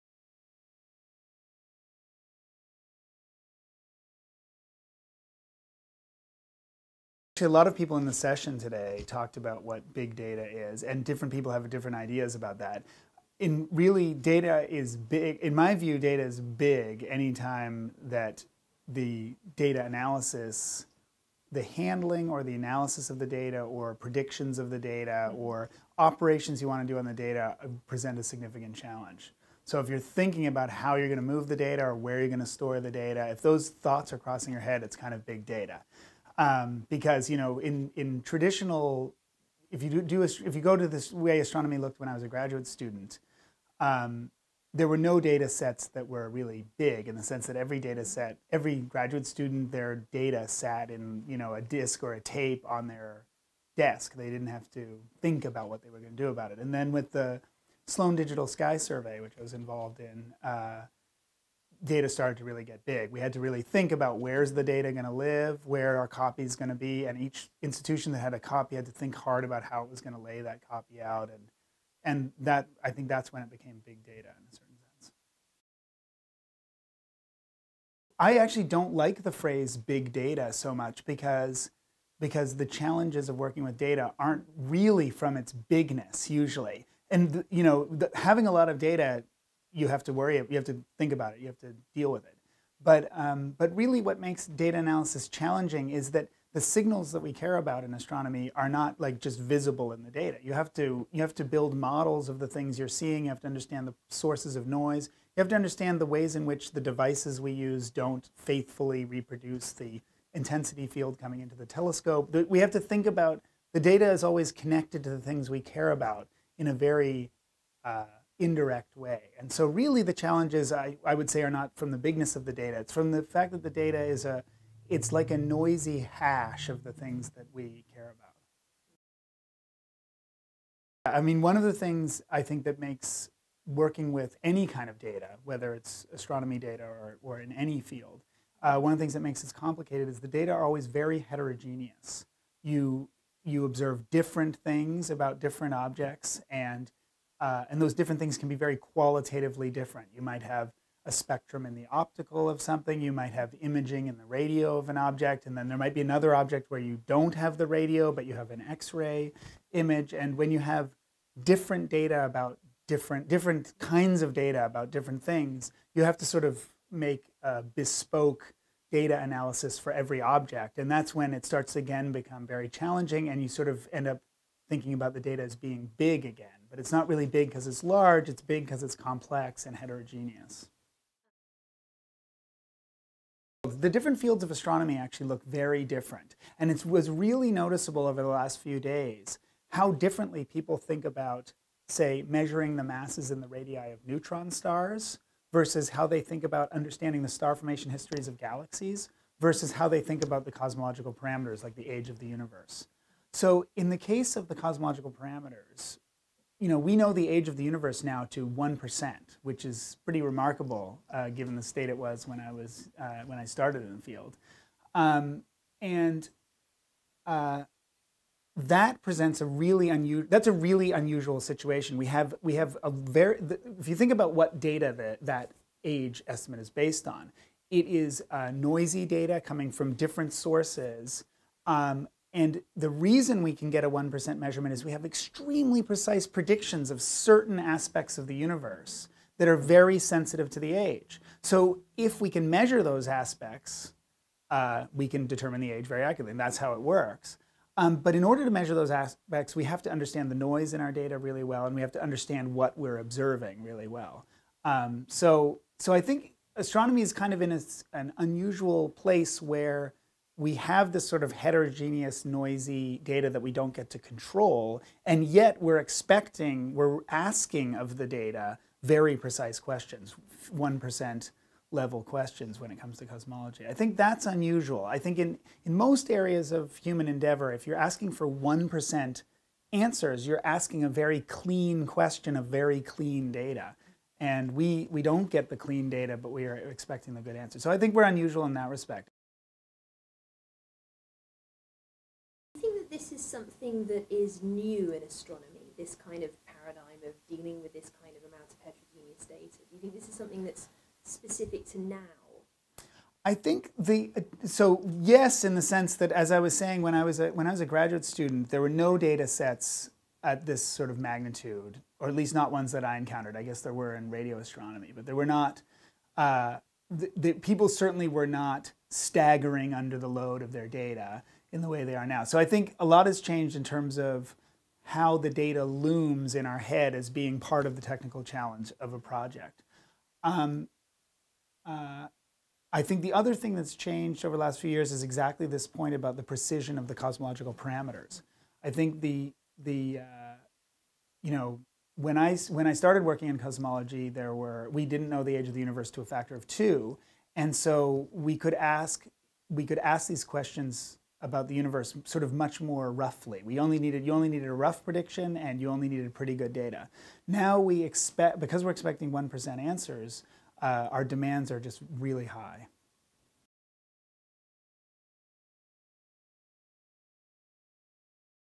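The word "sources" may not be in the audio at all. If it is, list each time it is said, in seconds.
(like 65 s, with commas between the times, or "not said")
104 s, 230 s.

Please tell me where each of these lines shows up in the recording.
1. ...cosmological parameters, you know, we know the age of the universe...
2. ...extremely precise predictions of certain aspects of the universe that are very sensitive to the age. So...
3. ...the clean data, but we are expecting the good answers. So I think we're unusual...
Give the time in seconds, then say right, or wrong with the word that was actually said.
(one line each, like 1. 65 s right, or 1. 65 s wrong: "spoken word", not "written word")
1. 204 s right
2. 235 s right
3. 285 s right.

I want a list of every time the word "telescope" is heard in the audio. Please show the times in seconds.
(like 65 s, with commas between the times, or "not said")
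111 s.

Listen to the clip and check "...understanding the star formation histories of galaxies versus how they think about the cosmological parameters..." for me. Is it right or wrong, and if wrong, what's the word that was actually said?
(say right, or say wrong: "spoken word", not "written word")
right.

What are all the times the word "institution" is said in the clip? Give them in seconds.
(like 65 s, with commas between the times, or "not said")
67 s.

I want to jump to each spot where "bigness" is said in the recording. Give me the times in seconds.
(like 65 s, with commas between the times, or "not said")
85 s, 121 s.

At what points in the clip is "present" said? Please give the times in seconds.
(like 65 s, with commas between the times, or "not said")
27 s, 219 s.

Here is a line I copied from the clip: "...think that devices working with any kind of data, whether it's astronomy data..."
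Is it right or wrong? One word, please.
wrong.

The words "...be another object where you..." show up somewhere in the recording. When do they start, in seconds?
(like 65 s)
155 s.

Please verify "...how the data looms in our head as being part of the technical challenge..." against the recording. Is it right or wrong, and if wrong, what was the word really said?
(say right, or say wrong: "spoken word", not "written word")
right.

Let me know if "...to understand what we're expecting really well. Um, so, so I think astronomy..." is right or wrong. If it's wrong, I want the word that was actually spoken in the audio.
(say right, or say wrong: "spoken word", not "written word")
wrong: "observing", not "expecting".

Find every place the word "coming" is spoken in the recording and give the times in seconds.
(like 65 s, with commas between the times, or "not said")
111 s, 229 s.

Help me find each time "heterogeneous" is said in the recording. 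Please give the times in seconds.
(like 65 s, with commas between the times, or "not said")
141 s, 179 s, 261 s, 298 s.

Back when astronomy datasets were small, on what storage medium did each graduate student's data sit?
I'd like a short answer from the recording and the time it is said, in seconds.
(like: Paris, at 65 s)
a tape, at 52 s.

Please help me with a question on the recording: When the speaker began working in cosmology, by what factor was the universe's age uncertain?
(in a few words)
a factor of 2.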